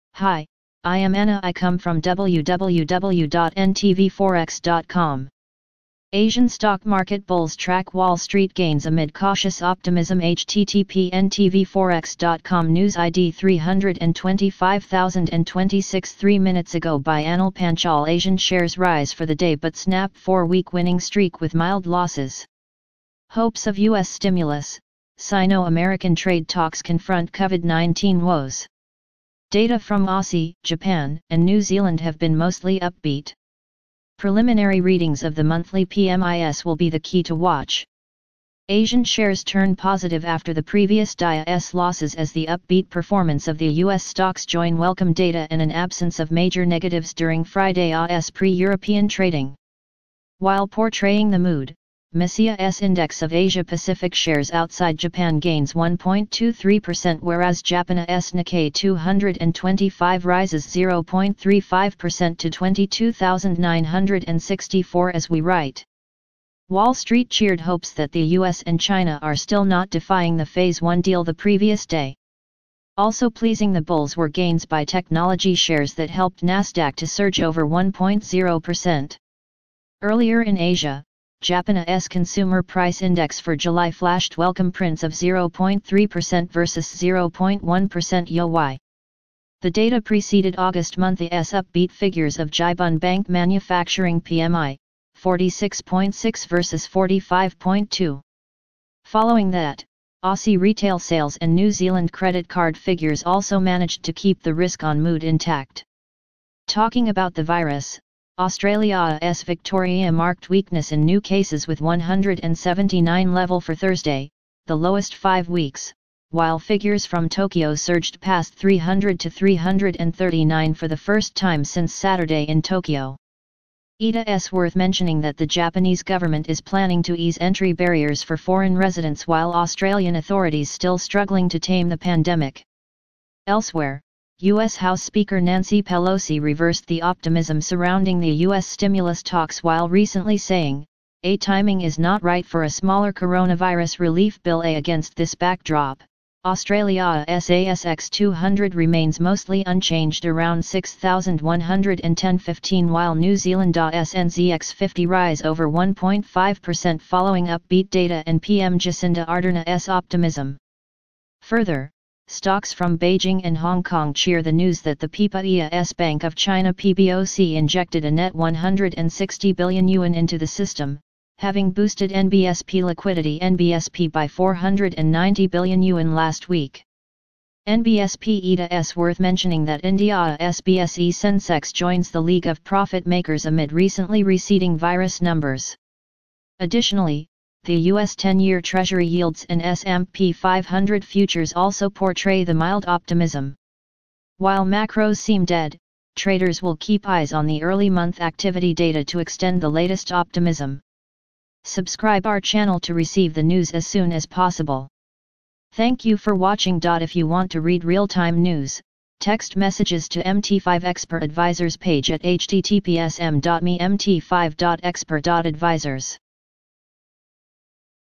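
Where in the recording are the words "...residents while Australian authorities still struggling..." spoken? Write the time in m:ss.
2:08.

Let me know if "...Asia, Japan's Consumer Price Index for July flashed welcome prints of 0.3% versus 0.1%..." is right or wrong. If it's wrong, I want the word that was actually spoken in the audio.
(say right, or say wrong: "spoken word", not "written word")
right.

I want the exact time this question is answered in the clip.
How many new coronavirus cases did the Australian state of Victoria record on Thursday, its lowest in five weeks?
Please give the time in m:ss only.
1:51.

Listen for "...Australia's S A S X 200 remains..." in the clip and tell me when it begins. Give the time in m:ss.
2:26.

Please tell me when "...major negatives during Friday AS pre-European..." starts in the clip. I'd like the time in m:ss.
0:46.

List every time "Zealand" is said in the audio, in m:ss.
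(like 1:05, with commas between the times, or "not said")
0:31, 1:41, 2:33.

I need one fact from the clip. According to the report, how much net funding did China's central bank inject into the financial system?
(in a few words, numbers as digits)
160 billion yuan.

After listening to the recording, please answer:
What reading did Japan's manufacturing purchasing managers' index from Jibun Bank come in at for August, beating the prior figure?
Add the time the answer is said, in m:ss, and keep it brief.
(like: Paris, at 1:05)
46.6, at 1:35.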